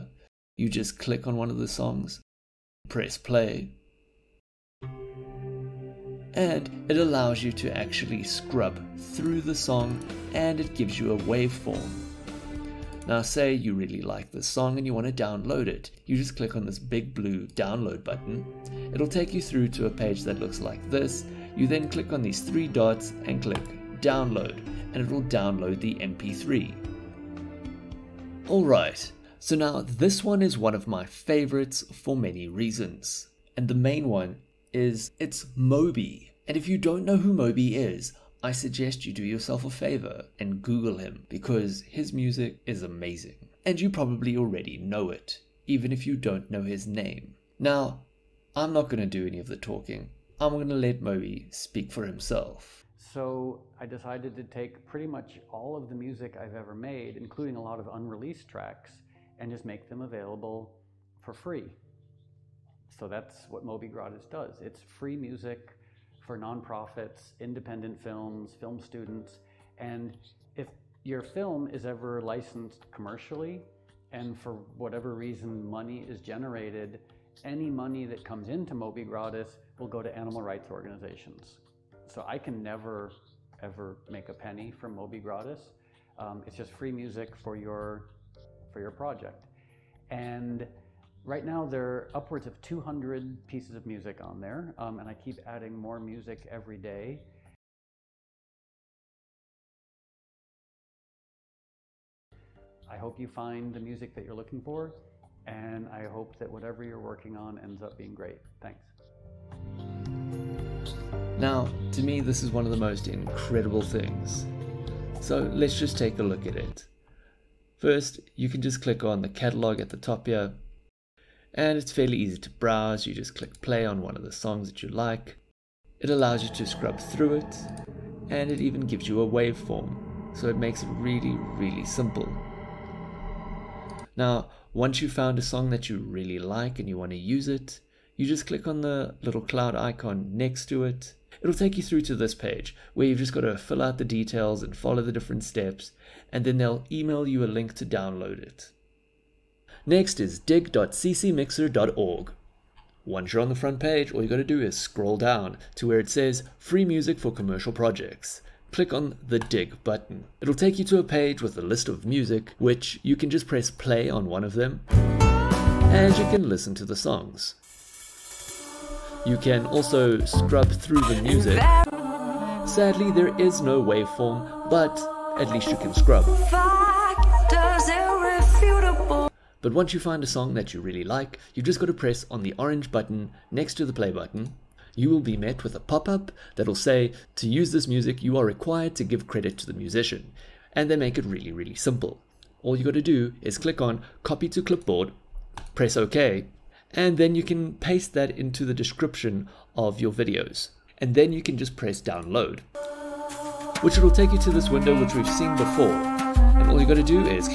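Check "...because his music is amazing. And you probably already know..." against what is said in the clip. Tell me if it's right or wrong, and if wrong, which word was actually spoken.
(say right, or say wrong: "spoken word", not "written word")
right.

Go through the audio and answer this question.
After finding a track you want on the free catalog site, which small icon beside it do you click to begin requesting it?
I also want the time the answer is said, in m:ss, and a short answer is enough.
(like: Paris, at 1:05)
cloud icon, at 2:19.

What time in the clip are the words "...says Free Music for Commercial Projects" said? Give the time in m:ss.
2:36.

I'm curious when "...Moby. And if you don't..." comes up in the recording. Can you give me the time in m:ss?
0:35.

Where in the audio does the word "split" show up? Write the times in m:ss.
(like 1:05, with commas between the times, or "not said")
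not said.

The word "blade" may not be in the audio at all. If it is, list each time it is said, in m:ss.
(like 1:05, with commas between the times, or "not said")
not said.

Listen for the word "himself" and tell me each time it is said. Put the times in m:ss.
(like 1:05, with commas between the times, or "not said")
0:52.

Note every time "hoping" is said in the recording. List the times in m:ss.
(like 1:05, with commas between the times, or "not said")
not said.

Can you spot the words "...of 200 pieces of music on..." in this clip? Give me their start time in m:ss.
1:32.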